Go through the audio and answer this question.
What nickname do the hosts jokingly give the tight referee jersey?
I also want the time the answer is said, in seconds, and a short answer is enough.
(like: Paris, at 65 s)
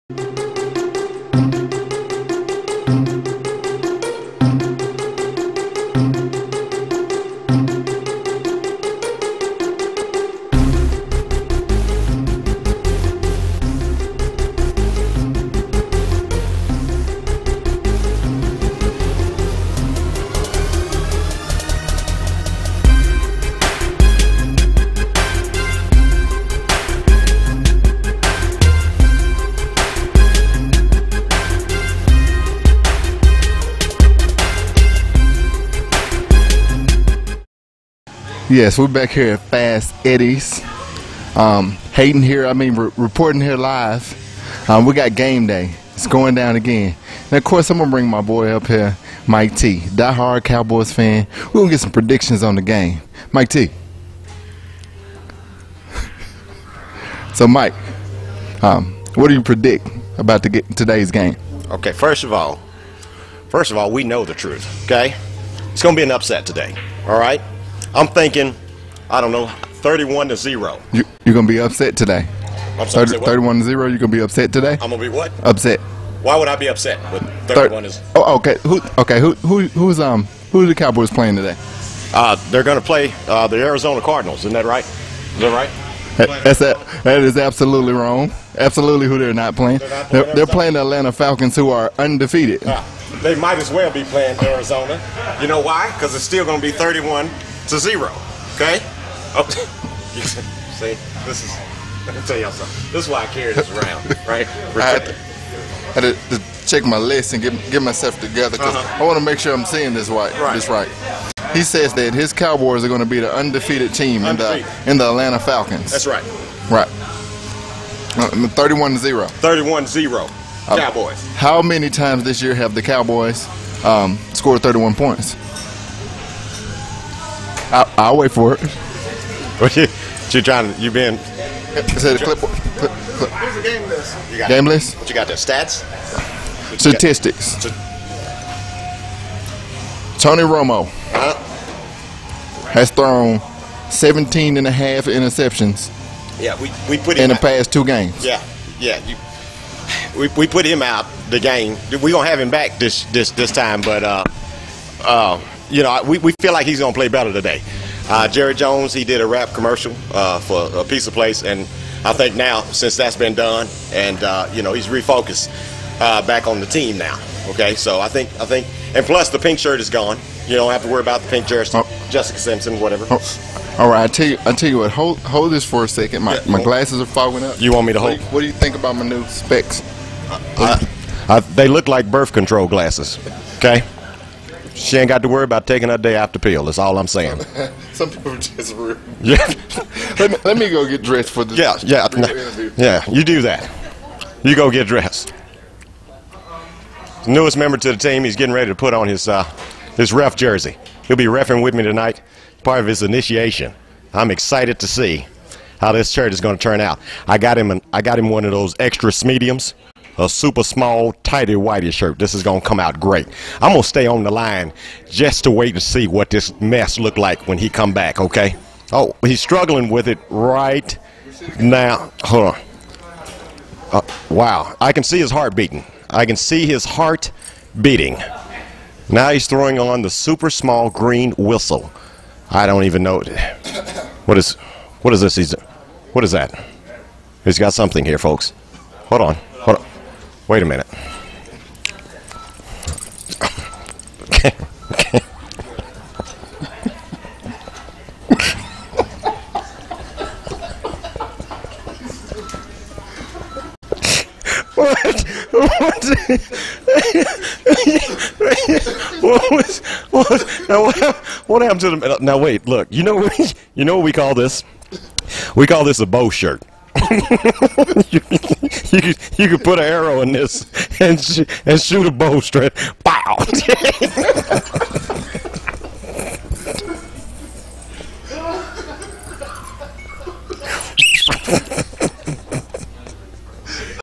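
bow shirt, at 266 s.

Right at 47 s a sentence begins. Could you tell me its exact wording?
And of course, I'm going to bring my boy up here, Mike T.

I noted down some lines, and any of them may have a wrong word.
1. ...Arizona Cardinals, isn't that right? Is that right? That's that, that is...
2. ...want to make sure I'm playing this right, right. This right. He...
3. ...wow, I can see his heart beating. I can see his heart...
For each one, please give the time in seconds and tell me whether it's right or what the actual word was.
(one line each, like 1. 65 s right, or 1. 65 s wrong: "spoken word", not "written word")
1. 83 s right
2. 109 s wrong: "seeing", not "playing"
3. 224 s right.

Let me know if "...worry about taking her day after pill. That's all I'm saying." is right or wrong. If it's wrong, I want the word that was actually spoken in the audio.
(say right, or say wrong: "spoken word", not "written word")
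right.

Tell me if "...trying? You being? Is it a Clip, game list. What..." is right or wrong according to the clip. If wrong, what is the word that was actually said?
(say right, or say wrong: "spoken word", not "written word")
right.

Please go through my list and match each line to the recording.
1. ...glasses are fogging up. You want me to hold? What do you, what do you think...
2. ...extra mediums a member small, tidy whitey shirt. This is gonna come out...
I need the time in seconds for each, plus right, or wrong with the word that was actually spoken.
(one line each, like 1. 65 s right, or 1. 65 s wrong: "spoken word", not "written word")
1. 176 s right
2. 208 s wrong: "super", not "member".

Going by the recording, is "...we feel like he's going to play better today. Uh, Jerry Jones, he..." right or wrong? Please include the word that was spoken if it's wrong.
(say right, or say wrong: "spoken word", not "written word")
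right.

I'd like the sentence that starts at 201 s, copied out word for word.
He'll be refing with me tonight.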